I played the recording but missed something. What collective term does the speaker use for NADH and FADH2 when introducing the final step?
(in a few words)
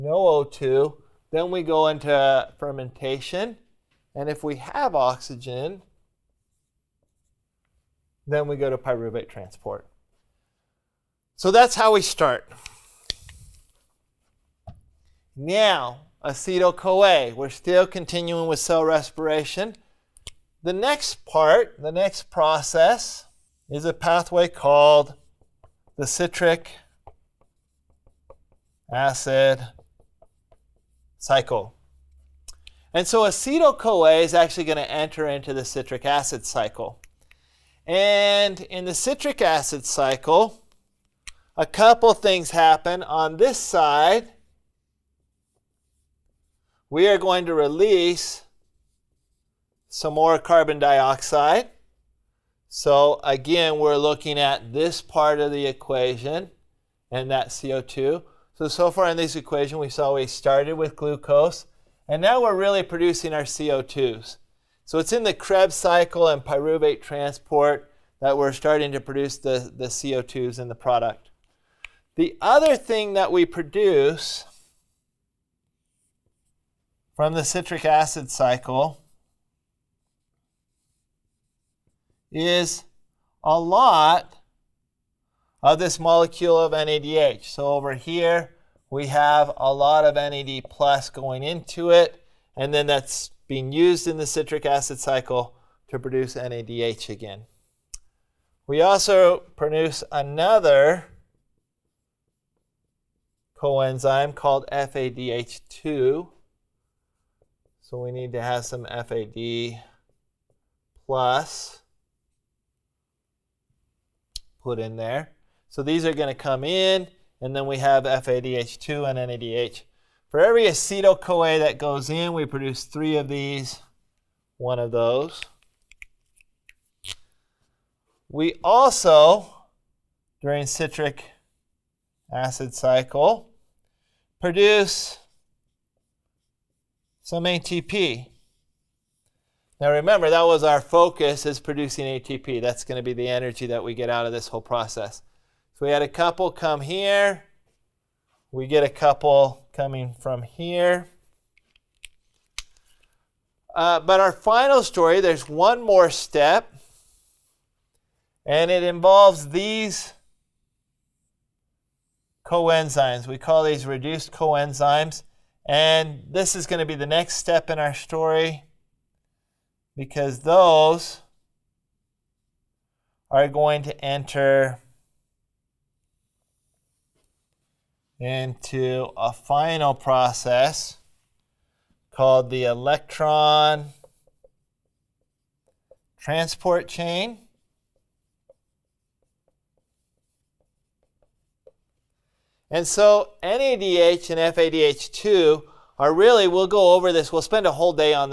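Reduced coenzymes.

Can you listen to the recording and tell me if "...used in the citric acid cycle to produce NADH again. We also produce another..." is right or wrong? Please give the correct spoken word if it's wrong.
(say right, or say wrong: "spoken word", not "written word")
right.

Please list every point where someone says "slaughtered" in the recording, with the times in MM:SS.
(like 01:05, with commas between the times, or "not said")
not said.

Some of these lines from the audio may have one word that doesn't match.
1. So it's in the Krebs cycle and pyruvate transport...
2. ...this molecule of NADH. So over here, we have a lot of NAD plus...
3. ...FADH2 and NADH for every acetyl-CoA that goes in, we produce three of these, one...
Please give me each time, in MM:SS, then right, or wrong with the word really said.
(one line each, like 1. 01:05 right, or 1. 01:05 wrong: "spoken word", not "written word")
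1. 01:04 right
2. 01:25 right
3. 01:58 right.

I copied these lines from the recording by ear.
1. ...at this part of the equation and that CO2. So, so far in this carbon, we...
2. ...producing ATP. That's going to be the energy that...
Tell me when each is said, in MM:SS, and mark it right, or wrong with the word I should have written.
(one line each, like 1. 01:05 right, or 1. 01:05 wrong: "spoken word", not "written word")
1. 00:54 wrong: "equation", not "carbon"
2. 02:21 right.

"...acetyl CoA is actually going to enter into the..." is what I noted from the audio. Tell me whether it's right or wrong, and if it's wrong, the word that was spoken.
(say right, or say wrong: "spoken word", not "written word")
right.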